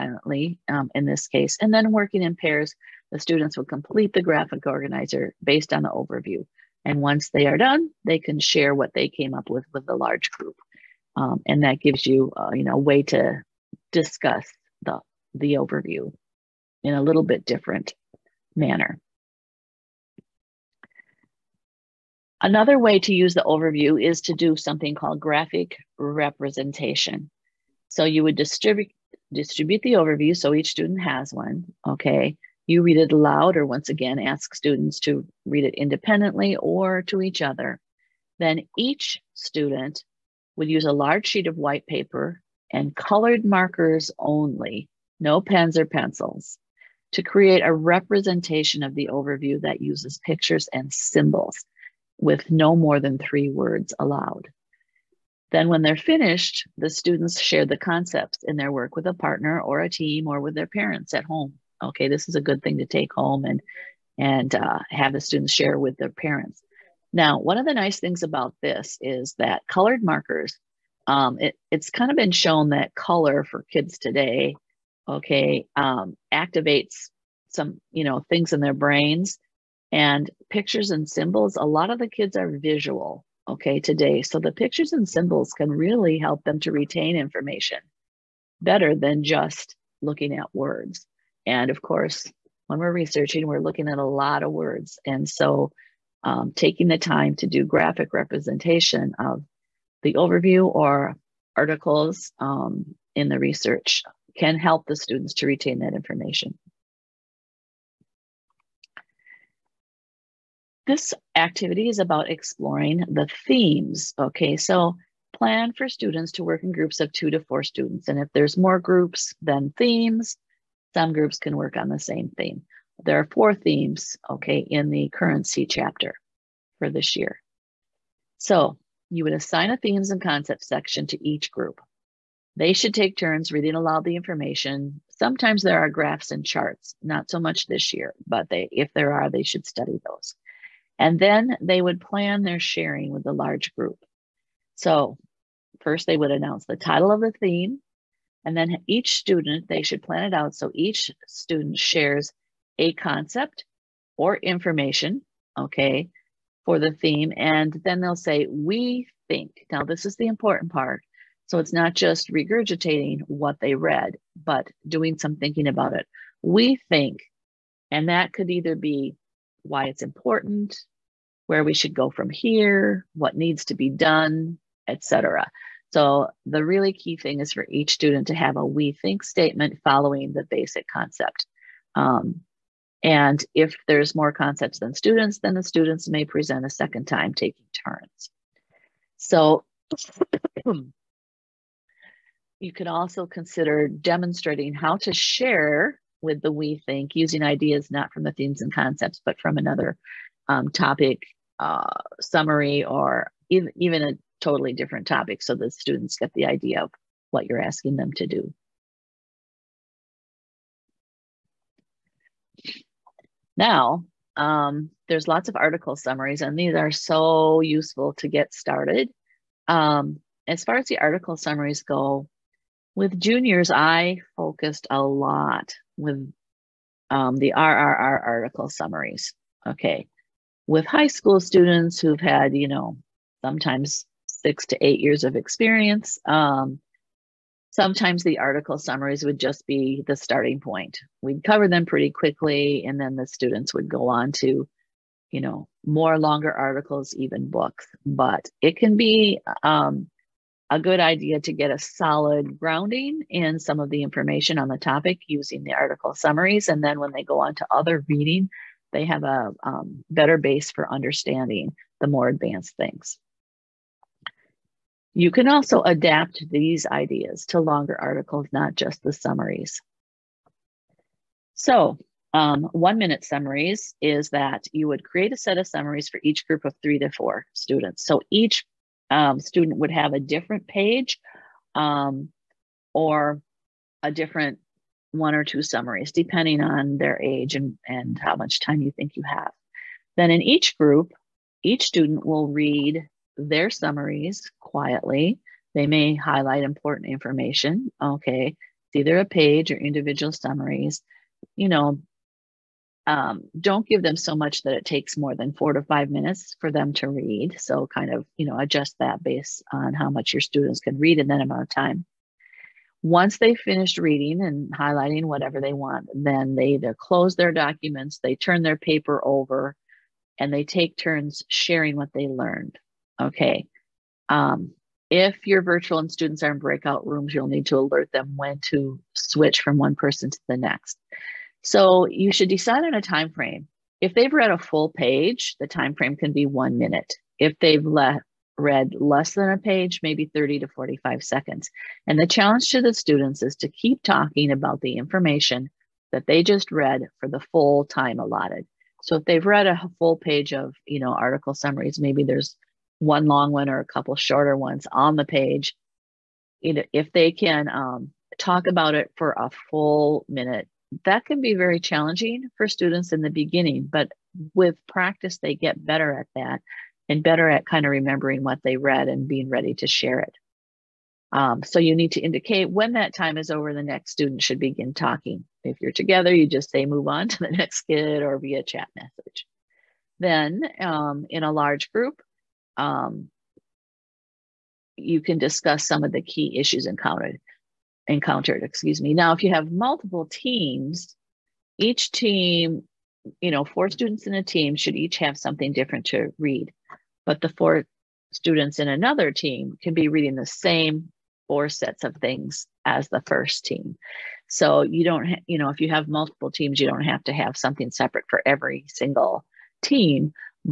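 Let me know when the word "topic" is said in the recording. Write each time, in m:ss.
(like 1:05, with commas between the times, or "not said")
3:20, 3:25, 4:14.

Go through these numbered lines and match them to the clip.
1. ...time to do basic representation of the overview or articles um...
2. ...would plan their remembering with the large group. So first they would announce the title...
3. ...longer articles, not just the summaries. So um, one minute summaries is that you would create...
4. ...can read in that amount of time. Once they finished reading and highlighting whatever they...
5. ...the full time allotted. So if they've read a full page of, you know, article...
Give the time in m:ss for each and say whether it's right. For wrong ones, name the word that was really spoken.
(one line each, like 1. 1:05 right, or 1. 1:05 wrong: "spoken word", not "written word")
1. 1:36 wrong: "graphic", not "basic"
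2. 2:21 wrong: "sharing", not "remembering"
3. 4:27 right
4. 5:10 right
5. 5:47 right.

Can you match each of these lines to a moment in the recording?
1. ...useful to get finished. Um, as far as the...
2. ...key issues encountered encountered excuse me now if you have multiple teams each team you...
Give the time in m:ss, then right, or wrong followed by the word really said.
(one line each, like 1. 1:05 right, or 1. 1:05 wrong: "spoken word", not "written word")
1. 3:37 wrong: "started", not "finished"
2. 6:26 right.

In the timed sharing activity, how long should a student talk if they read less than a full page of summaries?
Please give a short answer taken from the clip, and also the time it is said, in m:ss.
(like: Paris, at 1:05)
30 to 45 seconds, at 5:40.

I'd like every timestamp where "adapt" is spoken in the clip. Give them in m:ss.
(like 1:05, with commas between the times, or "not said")
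4:25.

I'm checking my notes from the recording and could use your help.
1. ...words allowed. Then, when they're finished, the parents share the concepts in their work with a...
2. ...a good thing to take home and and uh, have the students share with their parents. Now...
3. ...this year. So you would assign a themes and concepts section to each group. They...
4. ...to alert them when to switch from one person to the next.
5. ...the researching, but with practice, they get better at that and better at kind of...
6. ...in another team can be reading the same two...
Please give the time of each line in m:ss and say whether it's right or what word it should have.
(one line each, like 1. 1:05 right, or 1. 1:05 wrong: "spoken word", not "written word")
1. 0:53 wrong: "students", not "parents"
2. 1:02 right
3. 2:06 right
4. 5:27 right
5. 6:03 wrong: "beginning", not "researching"
6. 6:38 wrong: "four", not "two".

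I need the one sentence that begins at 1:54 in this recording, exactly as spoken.
Okay, so plan for students to work in groups of two to four students.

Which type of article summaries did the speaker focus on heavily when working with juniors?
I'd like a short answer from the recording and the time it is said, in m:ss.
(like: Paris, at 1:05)
RRR, at 3:47.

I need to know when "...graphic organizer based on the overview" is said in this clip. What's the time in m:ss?
0:04.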